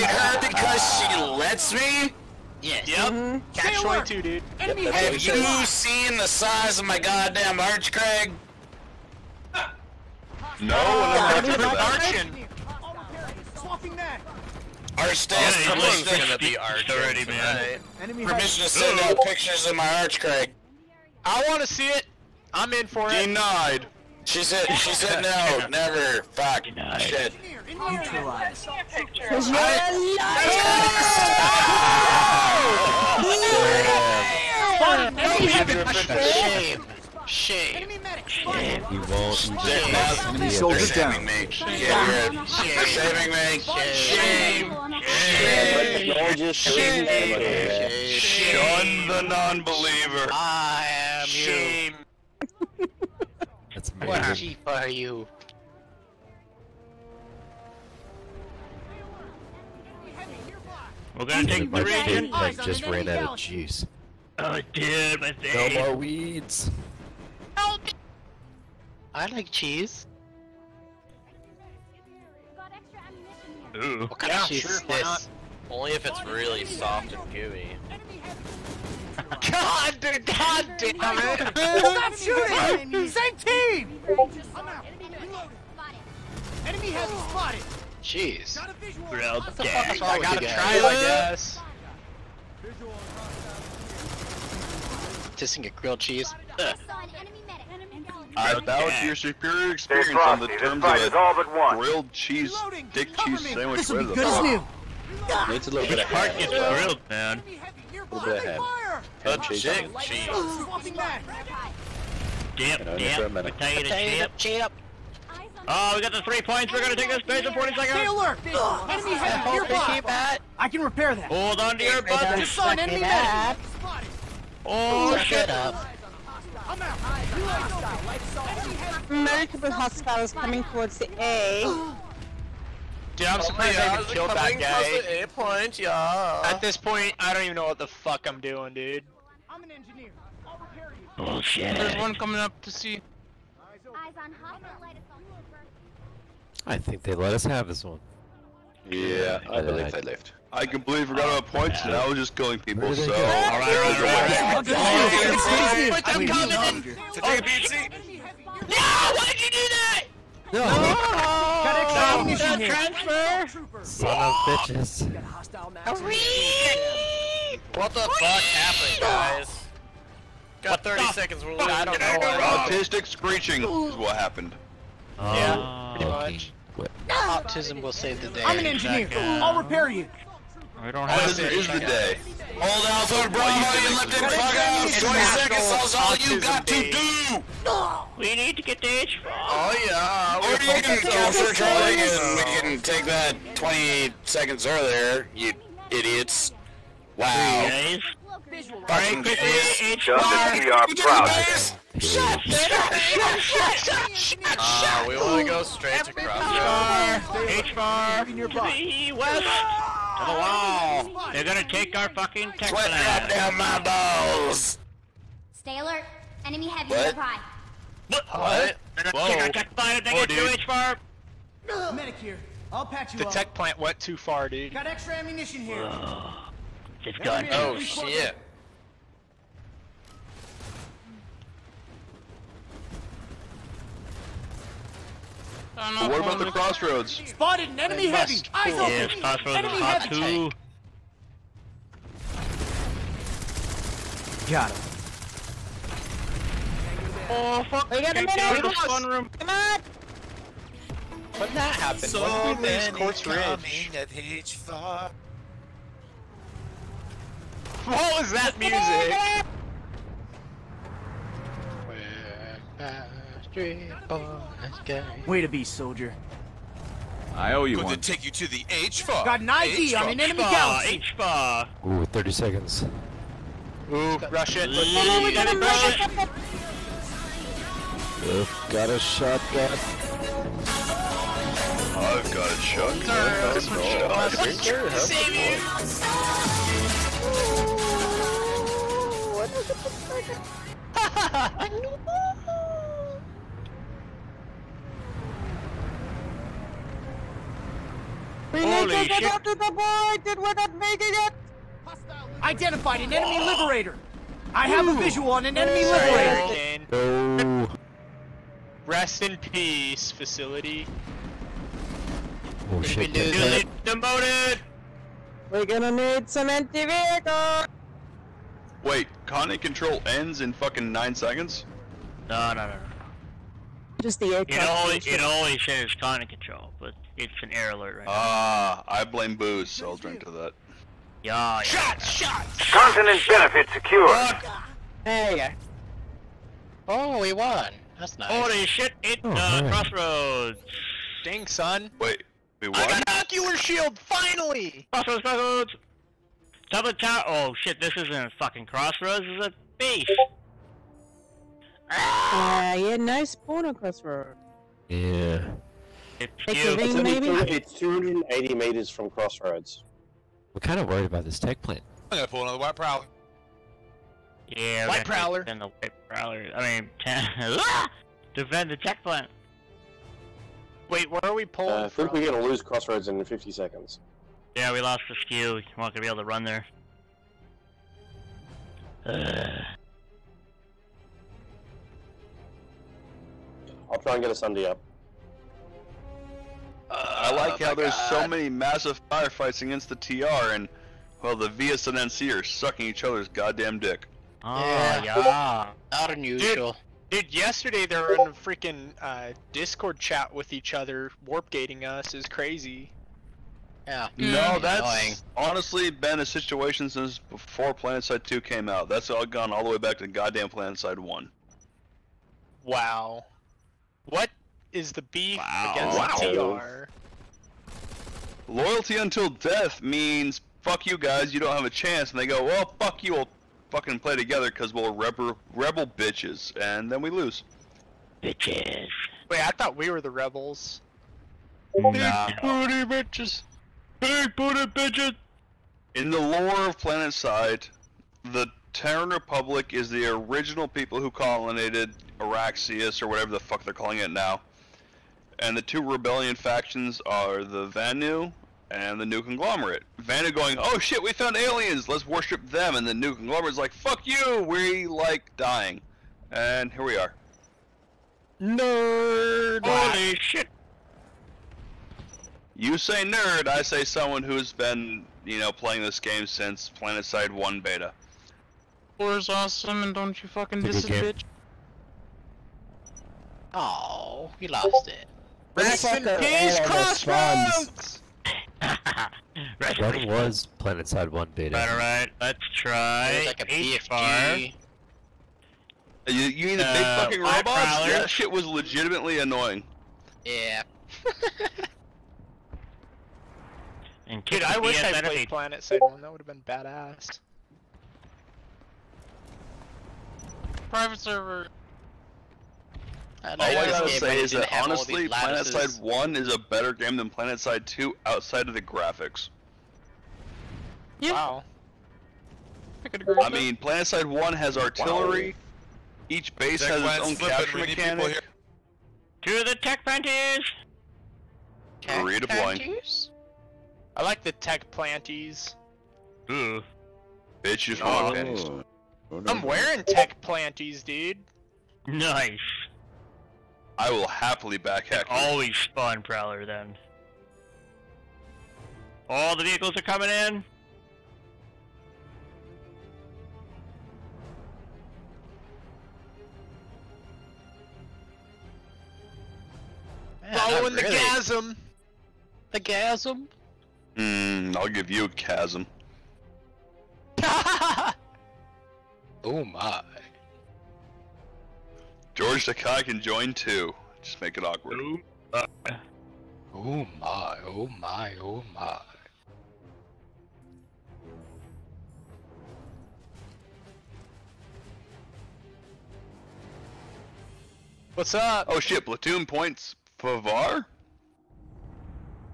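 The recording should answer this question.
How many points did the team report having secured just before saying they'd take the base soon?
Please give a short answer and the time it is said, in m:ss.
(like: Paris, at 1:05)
3, at 1:56.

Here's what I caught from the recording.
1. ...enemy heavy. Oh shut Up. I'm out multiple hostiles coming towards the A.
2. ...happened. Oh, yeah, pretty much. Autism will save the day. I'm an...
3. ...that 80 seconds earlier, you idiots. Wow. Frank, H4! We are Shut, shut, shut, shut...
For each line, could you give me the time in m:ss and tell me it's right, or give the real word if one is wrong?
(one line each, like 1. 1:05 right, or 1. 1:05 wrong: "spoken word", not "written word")
1. 2:02 right
2. 2:54 right
3. 3:13 wrong: "20", not "80".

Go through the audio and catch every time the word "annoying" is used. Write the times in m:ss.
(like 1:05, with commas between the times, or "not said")
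6:44, 8:09.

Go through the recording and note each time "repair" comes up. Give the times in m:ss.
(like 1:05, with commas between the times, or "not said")
2:00, 2:20, 2:59.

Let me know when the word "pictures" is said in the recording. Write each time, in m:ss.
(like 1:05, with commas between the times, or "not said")
0:19.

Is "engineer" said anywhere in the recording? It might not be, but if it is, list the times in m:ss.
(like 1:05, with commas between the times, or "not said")
2:19, 2:58.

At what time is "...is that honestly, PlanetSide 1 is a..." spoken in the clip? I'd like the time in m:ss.
8:24.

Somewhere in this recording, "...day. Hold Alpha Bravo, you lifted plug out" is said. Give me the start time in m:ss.
3:01.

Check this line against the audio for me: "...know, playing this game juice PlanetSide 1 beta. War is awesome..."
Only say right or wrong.
wrong.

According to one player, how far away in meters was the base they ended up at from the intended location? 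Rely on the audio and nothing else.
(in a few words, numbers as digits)
280 meters.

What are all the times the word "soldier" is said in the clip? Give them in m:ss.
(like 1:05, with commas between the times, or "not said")
0:40, 4:25.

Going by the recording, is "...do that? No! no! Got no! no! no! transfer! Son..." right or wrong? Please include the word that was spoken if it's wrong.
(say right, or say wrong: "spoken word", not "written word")
right.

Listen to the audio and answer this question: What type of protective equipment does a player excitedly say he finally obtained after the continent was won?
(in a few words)
Ocular shield.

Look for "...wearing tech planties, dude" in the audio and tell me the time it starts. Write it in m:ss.
8:49.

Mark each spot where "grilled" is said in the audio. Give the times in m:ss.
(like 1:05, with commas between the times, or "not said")
1:35, 1:41, 1:46.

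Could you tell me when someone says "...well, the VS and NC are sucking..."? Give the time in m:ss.
6:31.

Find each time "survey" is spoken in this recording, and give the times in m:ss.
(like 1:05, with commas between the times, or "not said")
not said.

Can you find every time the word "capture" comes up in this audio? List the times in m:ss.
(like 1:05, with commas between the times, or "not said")
3:10, 8:37.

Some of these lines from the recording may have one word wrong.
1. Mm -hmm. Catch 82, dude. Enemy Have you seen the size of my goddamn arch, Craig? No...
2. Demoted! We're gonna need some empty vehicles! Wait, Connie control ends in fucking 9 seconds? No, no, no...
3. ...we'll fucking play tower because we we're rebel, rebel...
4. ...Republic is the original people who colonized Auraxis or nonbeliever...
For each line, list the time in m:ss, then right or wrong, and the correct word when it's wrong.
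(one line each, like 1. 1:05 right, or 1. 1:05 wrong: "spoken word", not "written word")
1. 0:03 wrong: "22", not "82"
2. 5:13 right
3. 7:03 wrong: "together", not "tower"
4. 7:19 wrong: "whatever", not "nonbeliever".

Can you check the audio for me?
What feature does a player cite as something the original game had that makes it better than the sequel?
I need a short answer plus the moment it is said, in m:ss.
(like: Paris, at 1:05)
Artillery, at 8:34.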